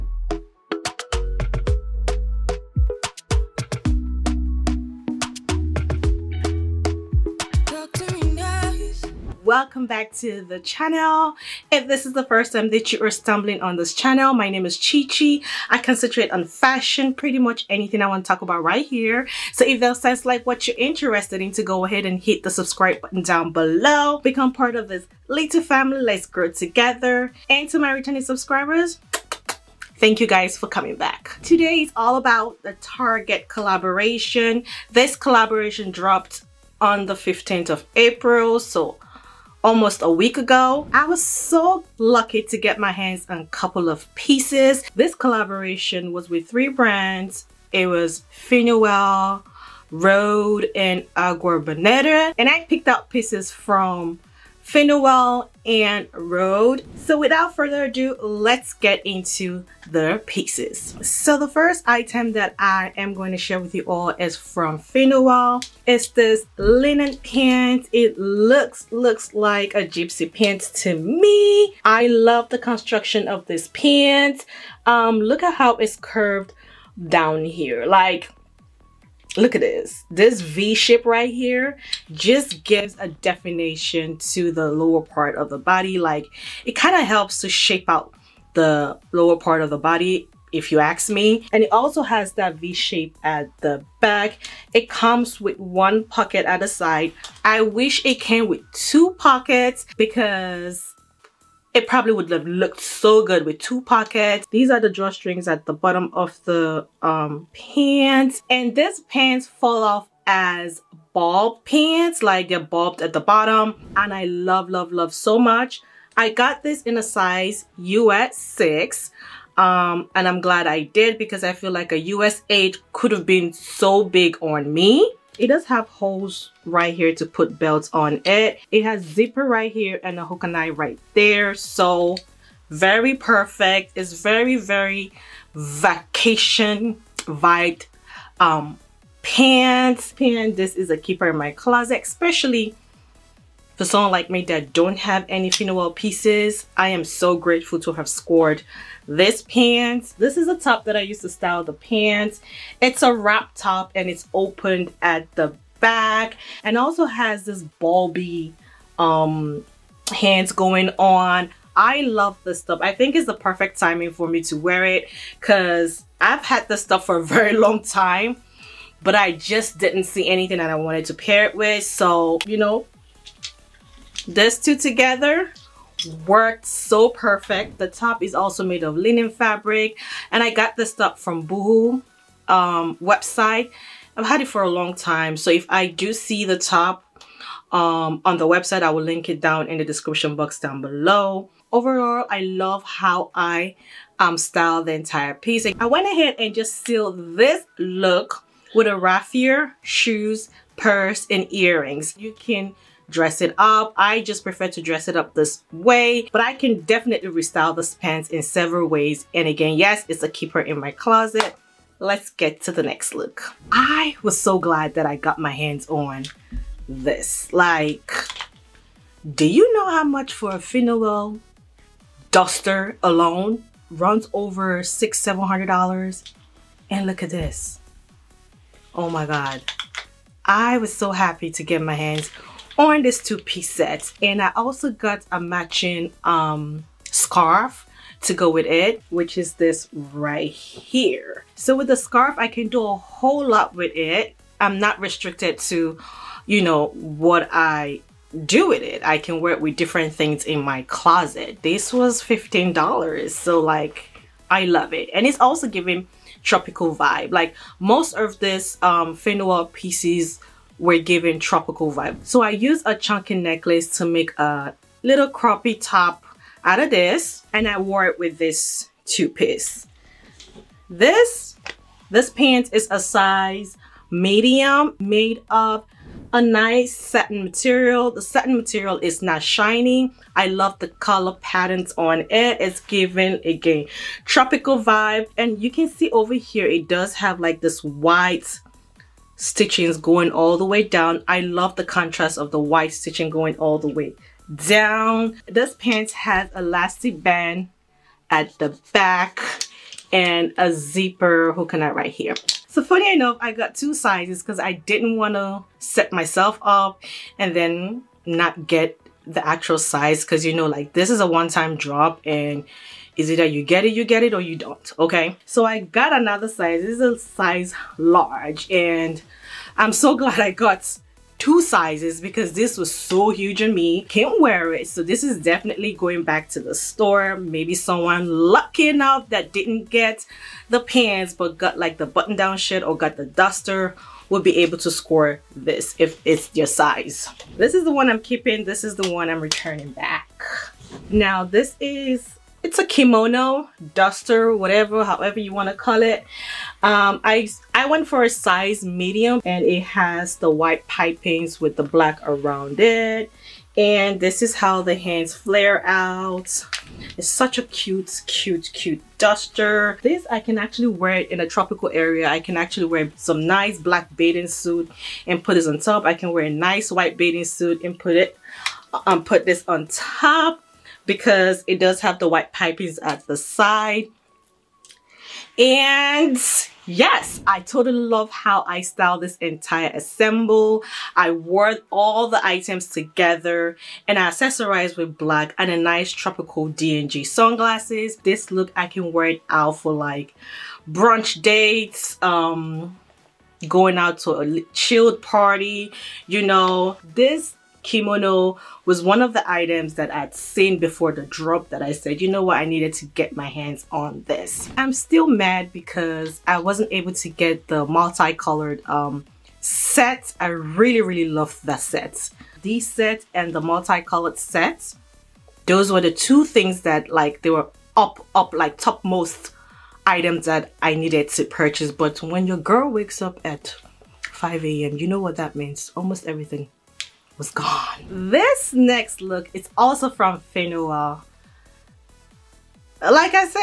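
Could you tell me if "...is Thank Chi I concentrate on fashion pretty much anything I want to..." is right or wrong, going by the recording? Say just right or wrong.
wrong.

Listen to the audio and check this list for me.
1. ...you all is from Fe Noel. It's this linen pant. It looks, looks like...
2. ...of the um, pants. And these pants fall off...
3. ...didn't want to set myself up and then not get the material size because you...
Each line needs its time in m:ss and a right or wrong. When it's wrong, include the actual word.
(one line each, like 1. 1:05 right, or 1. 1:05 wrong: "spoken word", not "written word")
1. 1:03 right
2. 1:46 right
3. 5:04 wrong: "actual", not "material".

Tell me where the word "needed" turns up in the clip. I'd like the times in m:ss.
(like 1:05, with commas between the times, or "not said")
6:42, 7:00.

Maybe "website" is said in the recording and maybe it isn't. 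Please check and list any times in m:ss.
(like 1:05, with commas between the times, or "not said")
3:02, 3:08.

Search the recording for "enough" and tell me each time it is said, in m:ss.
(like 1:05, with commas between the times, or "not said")
5:03, 5:28.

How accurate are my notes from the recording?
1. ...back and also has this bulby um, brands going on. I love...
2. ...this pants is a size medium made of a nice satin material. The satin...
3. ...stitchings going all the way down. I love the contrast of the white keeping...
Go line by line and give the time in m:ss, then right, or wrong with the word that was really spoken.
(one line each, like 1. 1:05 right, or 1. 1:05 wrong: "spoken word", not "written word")
1. 2:35 wrong: "hands", not "brands"
2. 4:32 right
3. 4:49 wrong: "stitching", not "keeping".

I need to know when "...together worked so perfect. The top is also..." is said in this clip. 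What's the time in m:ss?
2:54.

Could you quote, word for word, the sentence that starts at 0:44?
This collaboration was with three brands.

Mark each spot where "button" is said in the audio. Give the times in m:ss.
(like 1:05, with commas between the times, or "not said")
0:22, 5:32.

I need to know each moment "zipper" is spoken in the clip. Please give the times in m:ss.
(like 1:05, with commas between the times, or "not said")
2:09, 5:00.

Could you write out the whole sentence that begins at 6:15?
And yes, I totally love how I style this entire assemble.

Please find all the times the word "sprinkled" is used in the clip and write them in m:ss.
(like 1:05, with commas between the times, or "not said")
not said.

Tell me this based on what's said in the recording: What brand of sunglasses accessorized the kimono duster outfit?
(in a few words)
D&G.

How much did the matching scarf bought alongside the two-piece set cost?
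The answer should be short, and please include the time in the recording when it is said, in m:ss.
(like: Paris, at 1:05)
$15, at 4:12.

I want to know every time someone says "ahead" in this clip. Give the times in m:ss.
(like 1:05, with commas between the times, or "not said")
0:21, 3:16.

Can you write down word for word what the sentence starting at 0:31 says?
Today is all about the Target collaboration.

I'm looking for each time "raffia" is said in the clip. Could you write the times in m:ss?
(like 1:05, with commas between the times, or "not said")
3:18.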